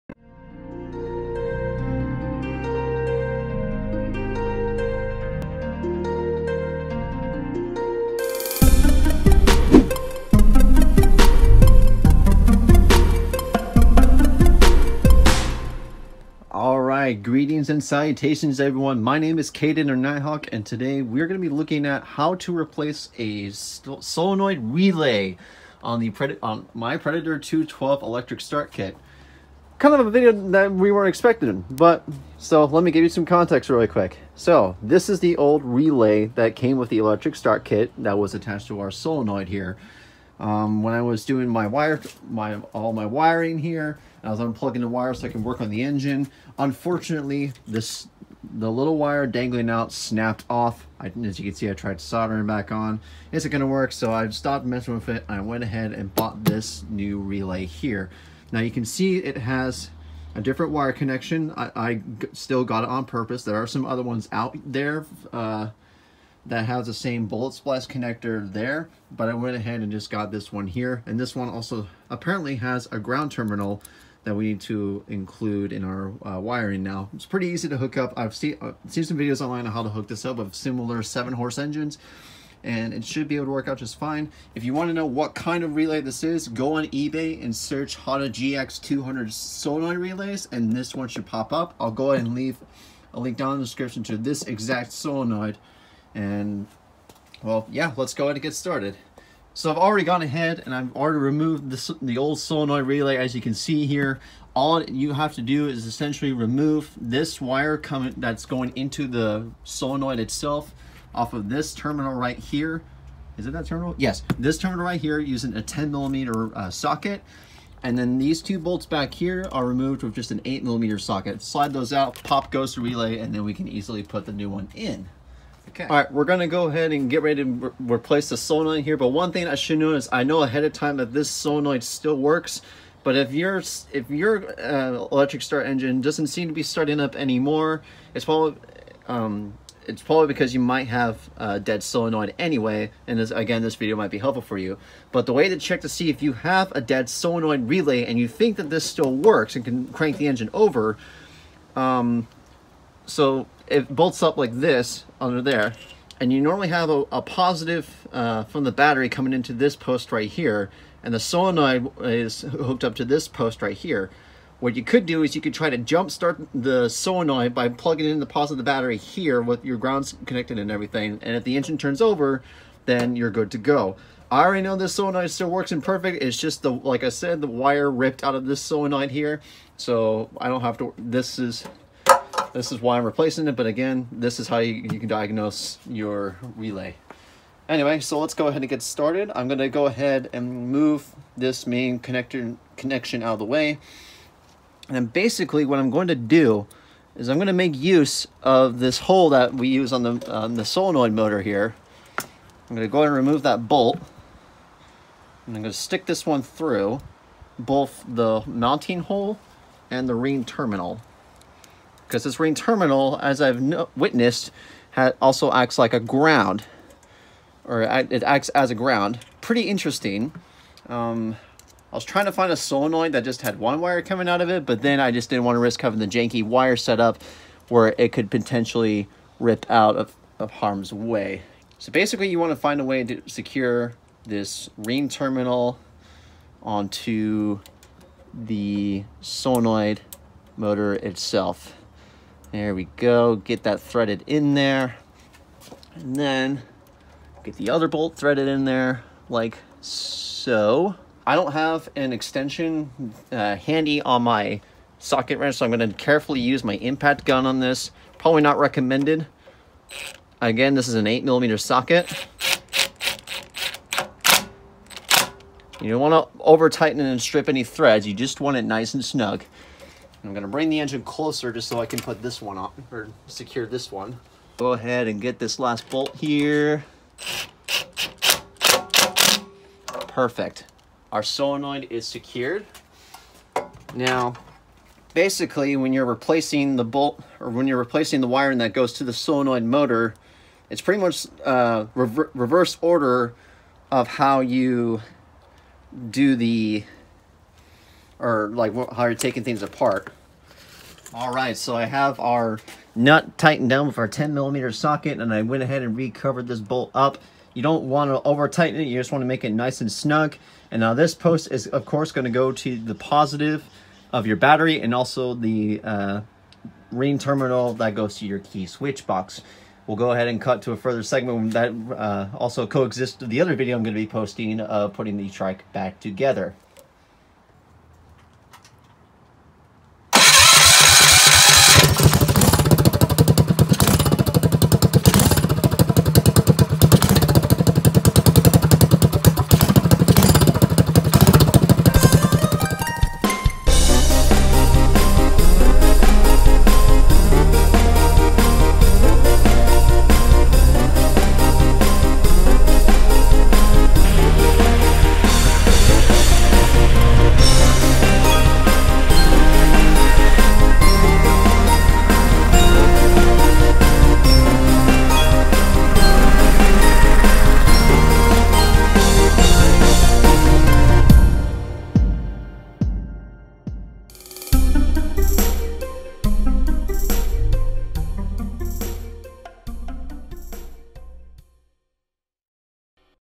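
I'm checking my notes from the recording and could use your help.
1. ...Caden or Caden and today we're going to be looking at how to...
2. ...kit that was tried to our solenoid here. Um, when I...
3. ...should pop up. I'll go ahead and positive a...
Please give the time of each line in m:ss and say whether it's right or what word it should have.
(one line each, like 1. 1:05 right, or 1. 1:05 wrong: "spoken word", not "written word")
1. 0:19 wrong: "Nighthawk", not "Caden"
2. 0:37 wrong: "attached", not "tried"
3. 1:31 wrong: "leave", not "positive".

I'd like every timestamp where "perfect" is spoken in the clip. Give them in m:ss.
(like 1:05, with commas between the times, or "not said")
2:55, 4:40.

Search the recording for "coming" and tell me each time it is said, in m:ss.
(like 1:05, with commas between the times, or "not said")
1:47, 2:39, 3:44.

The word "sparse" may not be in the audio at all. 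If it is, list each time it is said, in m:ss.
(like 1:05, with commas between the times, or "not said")
not said.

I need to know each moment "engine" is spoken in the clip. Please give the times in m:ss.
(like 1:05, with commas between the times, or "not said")
0:45, 1:21, 2:15, 2:30, 2:51, 4:30.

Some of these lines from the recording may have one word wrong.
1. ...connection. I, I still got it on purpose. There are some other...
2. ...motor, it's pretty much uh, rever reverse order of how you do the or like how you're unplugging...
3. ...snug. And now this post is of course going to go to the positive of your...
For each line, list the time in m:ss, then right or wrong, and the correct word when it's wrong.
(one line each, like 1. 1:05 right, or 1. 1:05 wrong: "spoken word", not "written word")
1. 1:00 right
2. 4:49 wrong: "taking", not "unplugging"
3. 5:09 right.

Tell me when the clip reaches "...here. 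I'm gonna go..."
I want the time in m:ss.
3:21.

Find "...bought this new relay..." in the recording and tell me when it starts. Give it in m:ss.
0:56.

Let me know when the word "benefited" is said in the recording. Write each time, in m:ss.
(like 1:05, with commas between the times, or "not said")
not said.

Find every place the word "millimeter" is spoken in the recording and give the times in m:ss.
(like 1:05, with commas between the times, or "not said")
1:55, 2:00, 4:21, 5:04.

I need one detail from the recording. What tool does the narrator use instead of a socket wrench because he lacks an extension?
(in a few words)
impact gun.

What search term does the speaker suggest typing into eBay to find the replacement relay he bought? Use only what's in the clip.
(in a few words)
Honda GX200 solenoid relays.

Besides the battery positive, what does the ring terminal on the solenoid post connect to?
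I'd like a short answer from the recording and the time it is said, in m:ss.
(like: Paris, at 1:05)
key switch box, at 5:18.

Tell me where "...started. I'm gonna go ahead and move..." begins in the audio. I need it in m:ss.
3:08.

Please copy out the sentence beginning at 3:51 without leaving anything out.
So basically you want to find a way to secure this ring terminal onto the solenoid motor itself.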